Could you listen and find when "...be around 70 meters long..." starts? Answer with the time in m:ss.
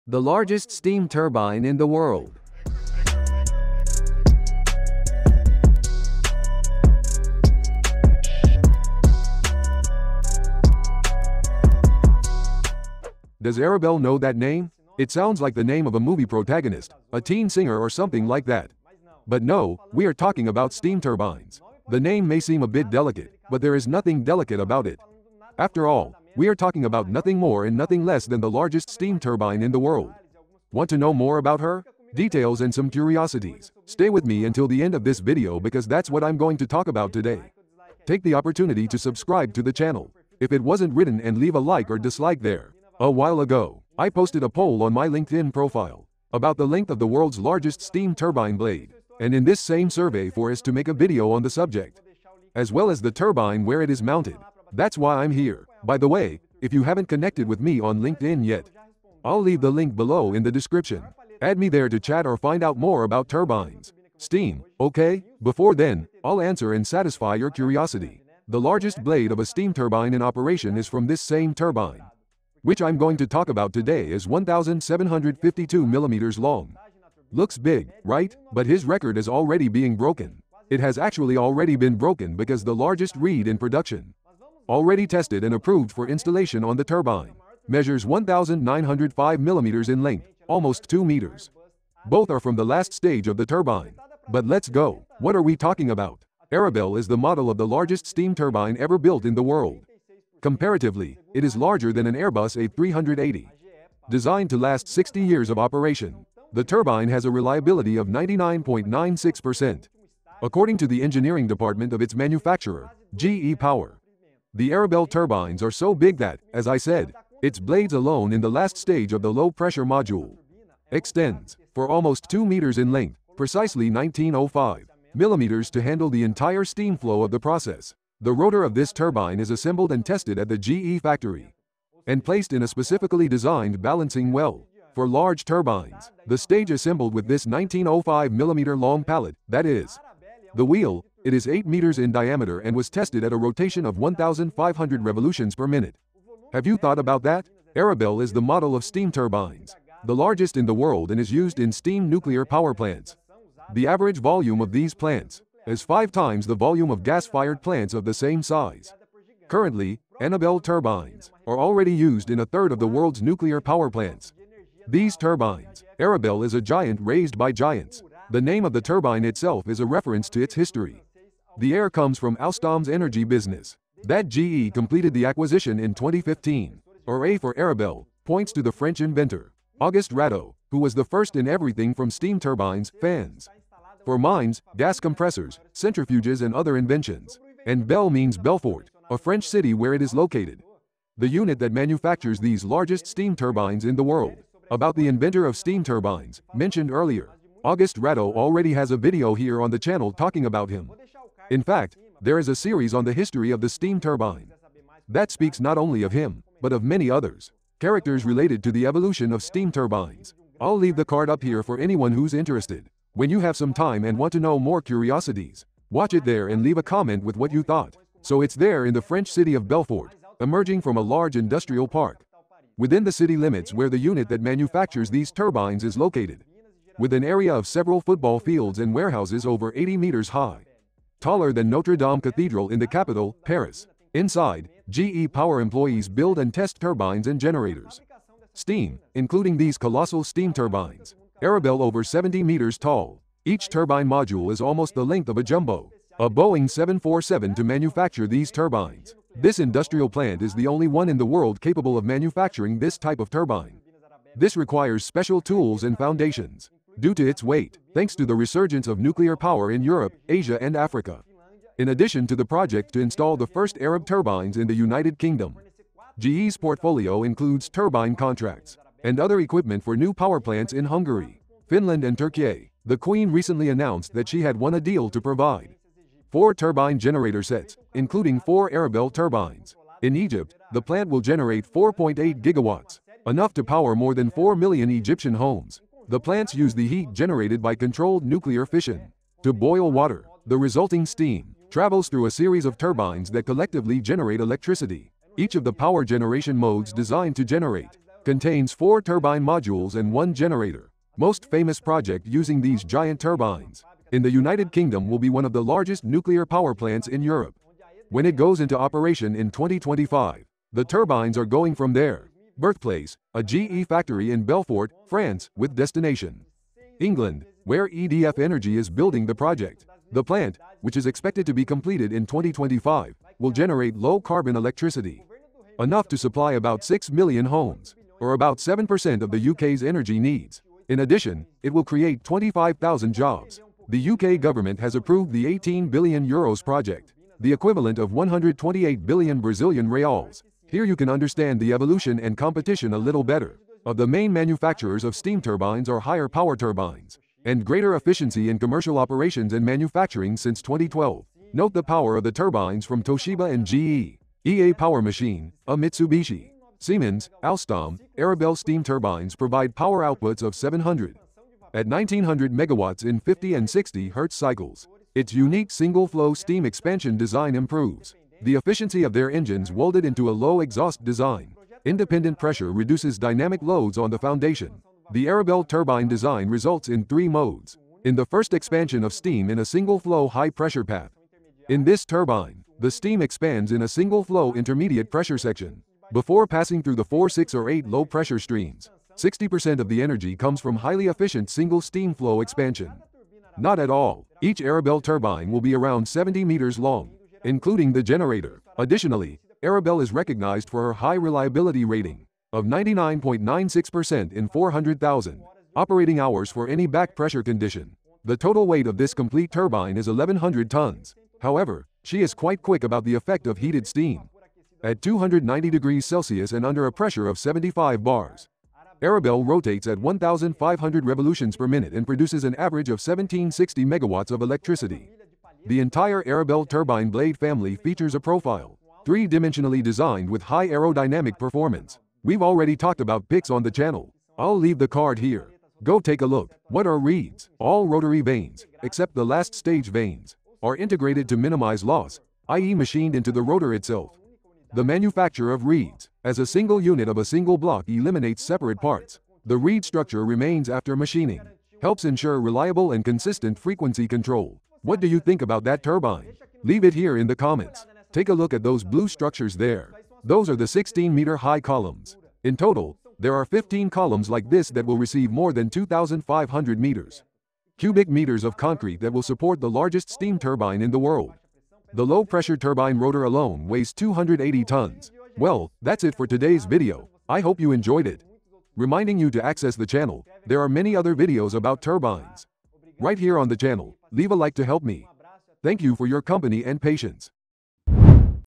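6:35.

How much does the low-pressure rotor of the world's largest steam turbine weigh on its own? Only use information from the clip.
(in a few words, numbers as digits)
280 tons.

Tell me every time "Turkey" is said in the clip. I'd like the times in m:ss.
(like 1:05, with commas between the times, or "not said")
4:32.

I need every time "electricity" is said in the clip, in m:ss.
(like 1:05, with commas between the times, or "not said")
4:54, 5:24, 7:04.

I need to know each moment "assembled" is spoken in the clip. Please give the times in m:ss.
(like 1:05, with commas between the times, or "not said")
2:09, 2:16.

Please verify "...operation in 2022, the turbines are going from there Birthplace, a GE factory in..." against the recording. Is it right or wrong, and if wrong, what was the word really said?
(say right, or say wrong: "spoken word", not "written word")
wrong: "2025", not "2022".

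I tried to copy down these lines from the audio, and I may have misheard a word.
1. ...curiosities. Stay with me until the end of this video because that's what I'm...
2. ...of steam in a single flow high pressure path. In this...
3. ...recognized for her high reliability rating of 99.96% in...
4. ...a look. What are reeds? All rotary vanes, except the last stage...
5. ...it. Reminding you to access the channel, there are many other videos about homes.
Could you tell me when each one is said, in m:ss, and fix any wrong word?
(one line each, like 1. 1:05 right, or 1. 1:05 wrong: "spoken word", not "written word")
1. 0:32 right
2. 6:19 right
3. 6:40 right
4. 7:16 right
5. 7:58 wrong: "turbines", not "homes".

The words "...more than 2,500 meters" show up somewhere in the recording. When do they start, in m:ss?
7:45.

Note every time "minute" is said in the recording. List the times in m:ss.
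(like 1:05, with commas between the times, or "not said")
2:25, 7:01.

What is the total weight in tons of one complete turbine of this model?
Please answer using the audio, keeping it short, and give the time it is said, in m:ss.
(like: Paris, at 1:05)
1,100 tons, at 6:50.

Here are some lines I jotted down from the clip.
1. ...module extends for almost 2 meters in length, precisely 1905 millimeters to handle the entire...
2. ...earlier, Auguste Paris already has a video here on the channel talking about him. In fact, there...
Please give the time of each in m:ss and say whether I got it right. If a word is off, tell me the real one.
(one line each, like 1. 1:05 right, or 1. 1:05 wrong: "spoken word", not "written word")
1. 1:59 right
2. 3:16 wrong: "Rateau", not "Paris".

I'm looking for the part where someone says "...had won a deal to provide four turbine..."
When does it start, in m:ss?
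4:34.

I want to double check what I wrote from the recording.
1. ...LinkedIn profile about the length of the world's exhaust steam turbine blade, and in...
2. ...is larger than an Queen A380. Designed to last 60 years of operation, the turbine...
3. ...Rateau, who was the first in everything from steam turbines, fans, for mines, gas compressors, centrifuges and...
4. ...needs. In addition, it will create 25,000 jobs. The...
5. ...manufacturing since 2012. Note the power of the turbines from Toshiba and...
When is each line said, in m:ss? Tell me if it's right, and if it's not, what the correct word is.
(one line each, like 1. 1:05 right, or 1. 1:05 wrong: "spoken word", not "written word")
1. 0:45 wrong: "largest", not "exhaust"
2. 1:41 wrong: "Airbus", not "Queen"
3. 3:00 right
4. 5:30 right
5. 5:49 right.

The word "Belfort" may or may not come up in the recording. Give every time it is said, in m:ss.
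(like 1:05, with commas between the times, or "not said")
3:08, 3:39, 5:14.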